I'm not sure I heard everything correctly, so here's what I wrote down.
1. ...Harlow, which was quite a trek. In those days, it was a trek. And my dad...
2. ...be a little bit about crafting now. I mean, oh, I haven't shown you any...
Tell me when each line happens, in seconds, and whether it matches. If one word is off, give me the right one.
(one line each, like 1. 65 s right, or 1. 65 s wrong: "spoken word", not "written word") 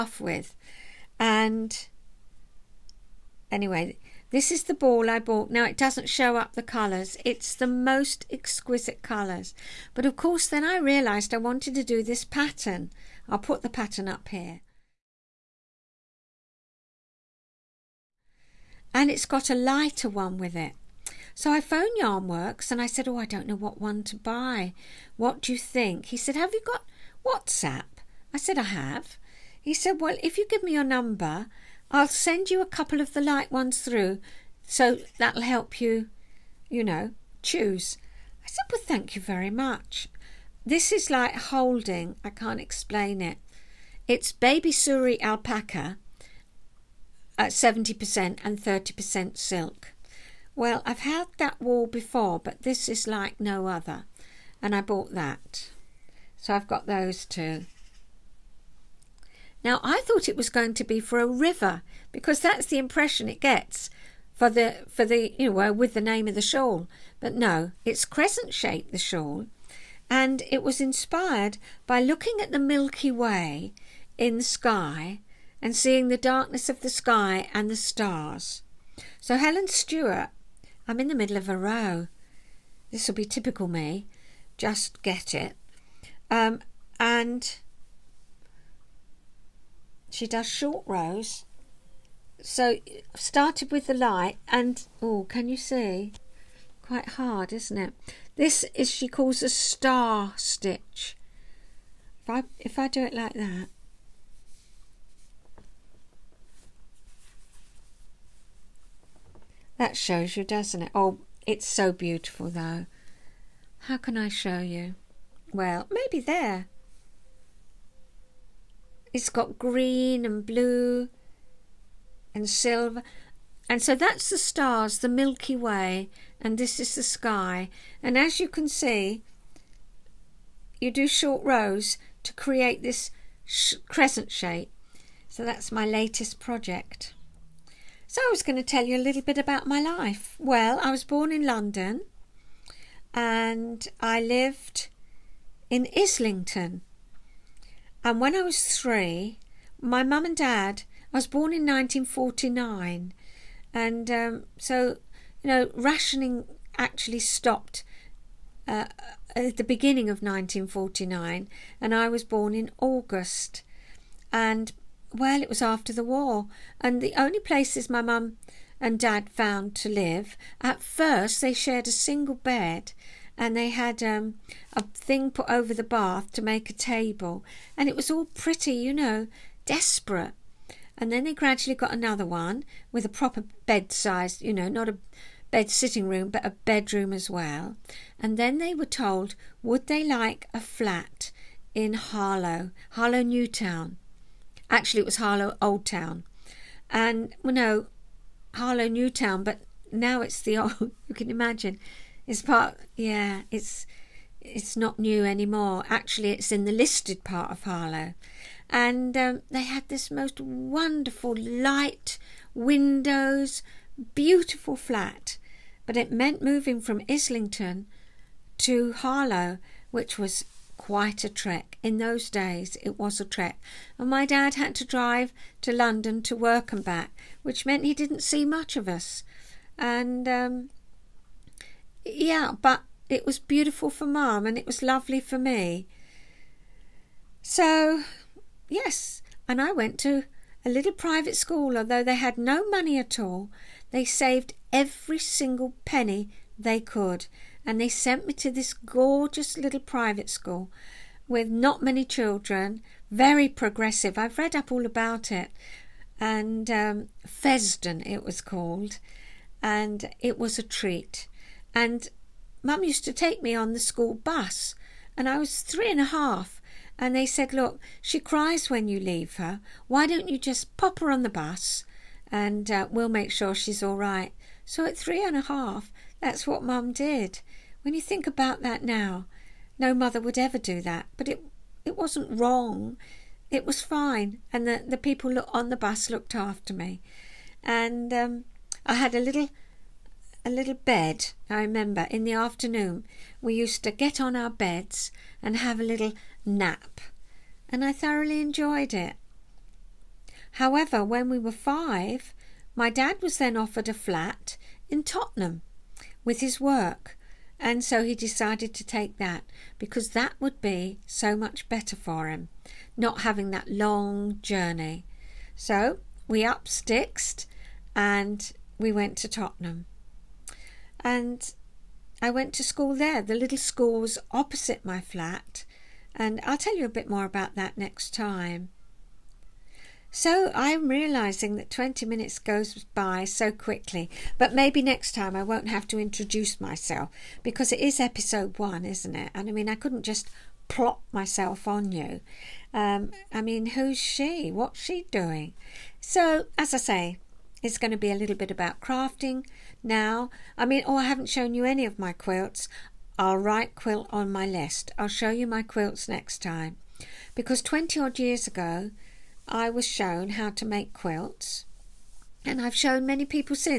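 1. 218 s right
2. 347 s right.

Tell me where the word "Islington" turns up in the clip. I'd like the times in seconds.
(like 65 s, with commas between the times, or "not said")
145 s, 217 s.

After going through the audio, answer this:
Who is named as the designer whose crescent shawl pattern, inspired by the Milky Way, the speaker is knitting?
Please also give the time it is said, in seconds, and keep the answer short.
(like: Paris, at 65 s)
Helen Stewart, at 79 s.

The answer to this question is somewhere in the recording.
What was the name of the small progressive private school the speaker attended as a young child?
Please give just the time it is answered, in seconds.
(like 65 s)
257 s.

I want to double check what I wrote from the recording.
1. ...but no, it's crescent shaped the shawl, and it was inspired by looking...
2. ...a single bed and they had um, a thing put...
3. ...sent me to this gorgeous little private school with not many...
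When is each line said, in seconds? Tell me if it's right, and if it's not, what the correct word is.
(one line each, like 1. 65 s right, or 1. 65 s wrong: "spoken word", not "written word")
1. 67 s right
2. 171 s right
3. 247 s right.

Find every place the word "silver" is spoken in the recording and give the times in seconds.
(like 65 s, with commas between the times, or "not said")
122 s.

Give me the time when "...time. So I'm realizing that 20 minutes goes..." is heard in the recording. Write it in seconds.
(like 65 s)
328 s.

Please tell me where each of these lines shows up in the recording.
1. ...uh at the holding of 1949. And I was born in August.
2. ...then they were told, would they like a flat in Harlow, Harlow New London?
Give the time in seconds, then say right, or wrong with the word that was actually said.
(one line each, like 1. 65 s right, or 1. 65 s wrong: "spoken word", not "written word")
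1. 158 s wrong: "beginning", not "holding"
2. 188 s wrong: "Town", not "London".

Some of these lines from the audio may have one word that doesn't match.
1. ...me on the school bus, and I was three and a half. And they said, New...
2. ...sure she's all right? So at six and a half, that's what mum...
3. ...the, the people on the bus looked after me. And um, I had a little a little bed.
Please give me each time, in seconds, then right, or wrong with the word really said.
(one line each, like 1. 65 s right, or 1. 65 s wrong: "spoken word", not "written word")
1. 263 s wrong: "Look", not "New"
2. 273 s wrong: "three", not "six"
3. 284 s right.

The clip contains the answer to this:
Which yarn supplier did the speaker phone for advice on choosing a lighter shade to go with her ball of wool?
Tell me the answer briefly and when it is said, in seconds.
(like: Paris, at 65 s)
Yarnworks, at 22 s.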